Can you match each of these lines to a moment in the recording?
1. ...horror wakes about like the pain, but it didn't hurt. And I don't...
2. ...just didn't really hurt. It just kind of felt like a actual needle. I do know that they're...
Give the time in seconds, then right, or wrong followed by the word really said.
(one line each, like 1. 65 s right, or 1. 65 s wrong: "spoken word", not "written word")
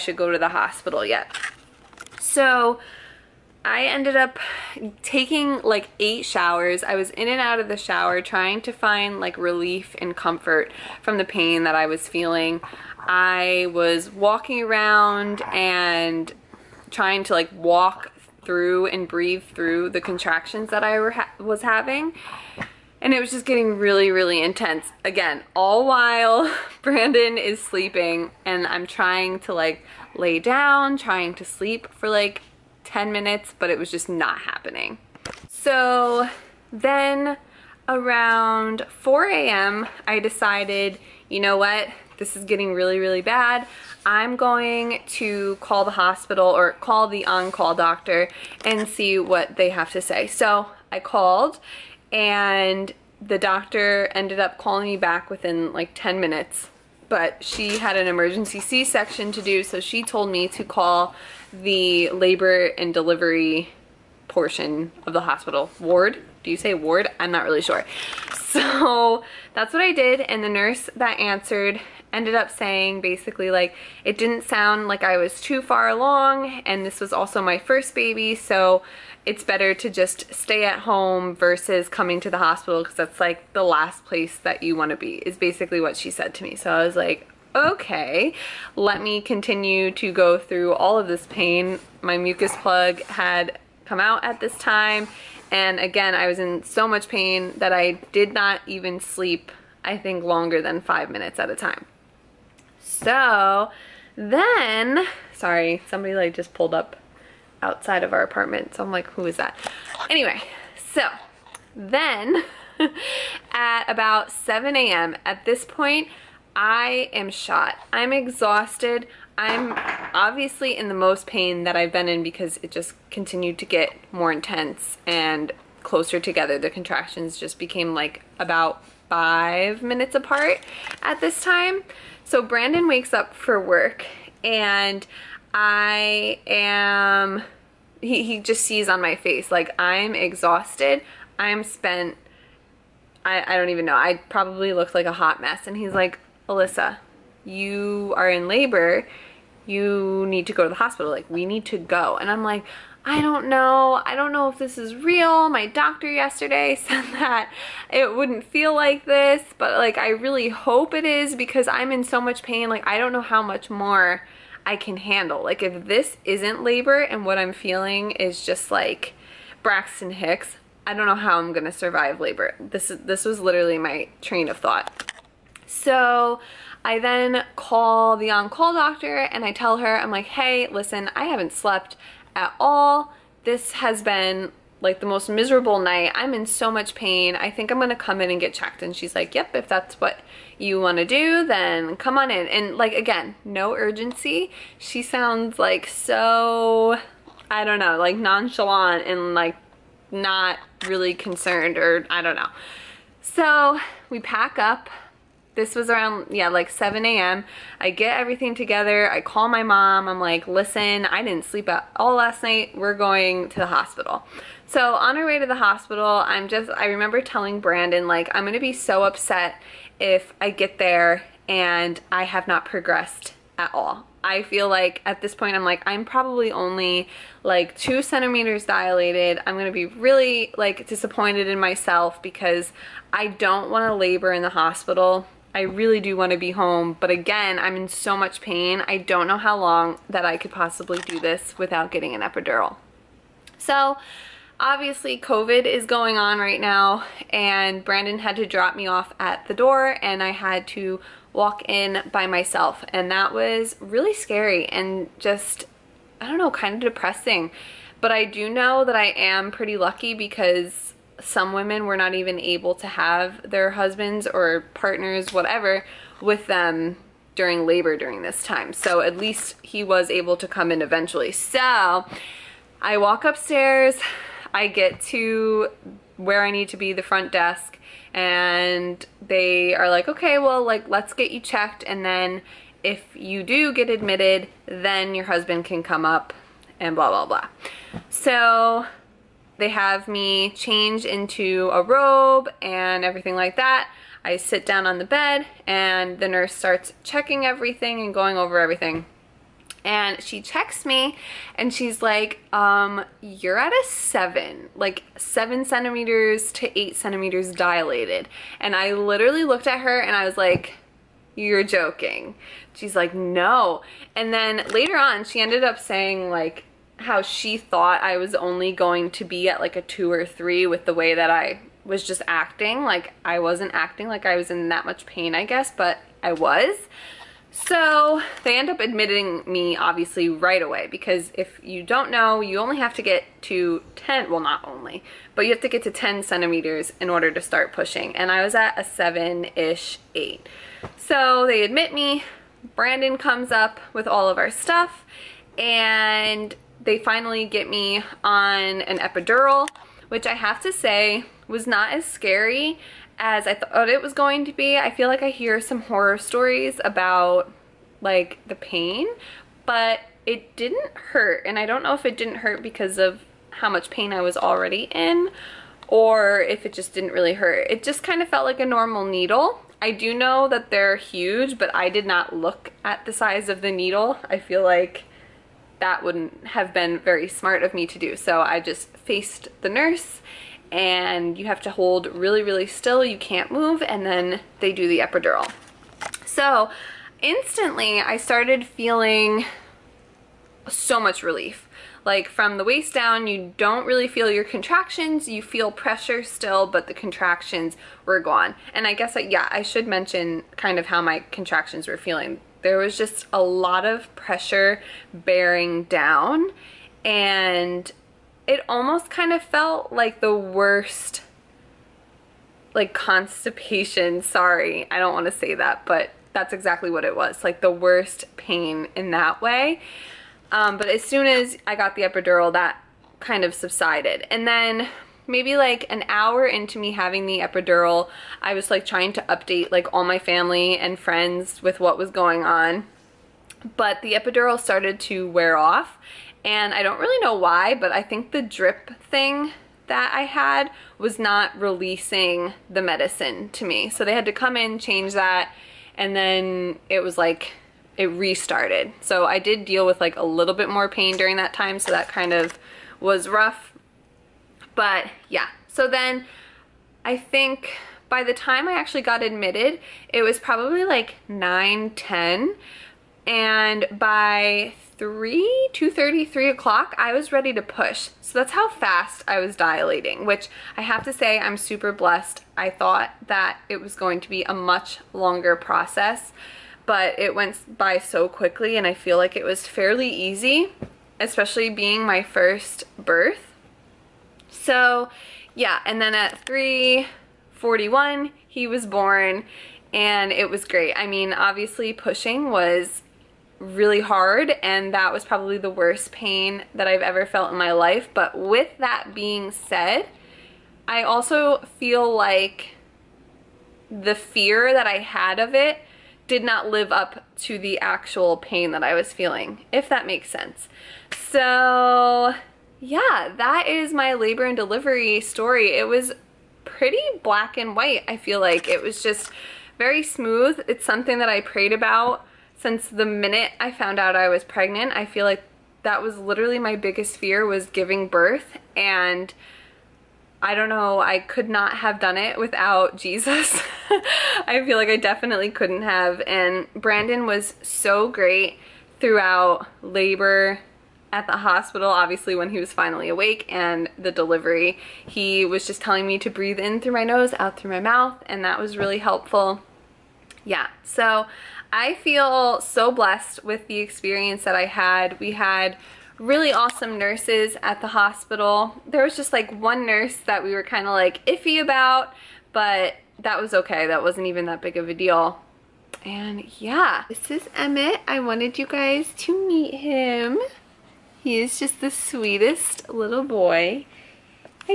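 1. 355 s wrong: "stories", not "wakes"
2. 366 s wrong: "normal", not "actual".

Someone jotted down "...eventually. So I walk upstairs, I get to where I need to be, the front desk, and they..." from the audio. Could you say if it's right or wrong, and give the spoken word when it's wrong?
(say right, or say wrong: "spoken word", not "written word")
right.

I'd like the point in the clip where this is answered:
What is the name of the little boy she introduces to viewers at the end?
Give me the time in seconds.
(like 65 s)
567 s.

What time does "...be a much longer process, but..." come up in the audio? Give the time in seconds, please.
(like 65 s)
474 s.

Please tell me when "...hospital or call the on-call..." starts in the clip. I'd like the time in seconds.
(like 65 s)
45 s.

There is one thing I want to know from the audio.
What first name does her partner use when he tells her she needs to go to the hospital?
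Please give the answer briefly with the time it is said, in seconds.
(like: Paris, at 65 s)
Allyssa, at 146 s.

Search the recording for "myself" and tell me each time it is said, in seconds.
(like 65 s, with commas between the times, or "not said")
231 s, 252 s.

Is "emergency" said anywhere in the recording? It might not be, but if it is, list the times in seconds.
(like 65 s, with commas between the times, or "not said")
58 s.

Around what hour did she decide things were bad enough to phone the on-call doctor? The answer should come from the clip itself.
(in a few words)
4 a.m.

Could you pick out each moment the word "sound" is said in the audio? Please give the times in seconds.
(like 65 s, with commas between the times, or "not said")
74 s, 195 s.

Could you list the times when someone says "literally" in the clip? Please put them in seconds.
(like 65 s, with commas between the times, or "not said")
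173 s, 308 s, 526 s.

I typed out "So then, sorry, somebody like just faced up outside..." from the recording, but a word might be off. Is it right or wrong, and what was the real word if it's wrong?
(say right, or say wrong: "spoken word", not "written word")
wrong: "pulled", not "faced".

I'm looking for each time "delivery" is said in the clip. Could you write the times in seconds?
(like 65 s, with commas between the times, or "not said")
62 s, 514 s, 544 s.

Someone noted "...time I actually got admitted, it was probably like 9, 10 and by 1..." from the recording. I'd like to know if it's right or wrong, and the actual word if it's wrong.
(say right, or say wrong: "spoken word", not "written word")
wrong: "3", not "1".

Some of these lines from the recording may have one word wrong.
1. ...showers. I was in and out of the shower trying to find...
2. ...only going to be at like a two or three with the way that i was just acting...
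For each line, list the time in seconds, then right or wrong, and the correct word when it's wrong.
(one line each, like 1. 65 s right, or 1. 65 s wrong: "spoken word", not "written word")
1. 6 s right
2. 318 s right.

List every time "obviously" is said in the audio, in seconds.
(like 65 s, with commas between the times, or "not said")
120 s, 244 s, 329 s, 491 s, 541 s.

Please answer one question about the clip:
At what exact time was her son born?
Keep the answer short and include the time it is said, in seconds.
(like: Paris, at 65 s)
3:41, at 486 s.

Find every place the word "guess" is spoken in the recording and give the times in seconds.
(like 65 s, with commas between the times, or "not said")
325 s, 398 s.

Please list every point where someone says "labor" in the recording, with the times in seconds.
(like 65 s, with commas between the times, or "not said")
62 s, 148 s, 166 s, 172 s, 233 s, 267 s, 514 s, 539 s.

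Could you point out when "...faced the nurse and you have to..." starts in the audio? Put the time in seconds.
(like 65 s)
378 s.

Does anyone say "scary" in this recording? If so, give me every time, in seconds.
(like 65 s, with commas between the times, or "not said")
254 s, 352 s.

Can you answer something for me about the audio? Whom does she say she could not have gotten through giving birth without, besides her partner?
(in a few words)
Jesus.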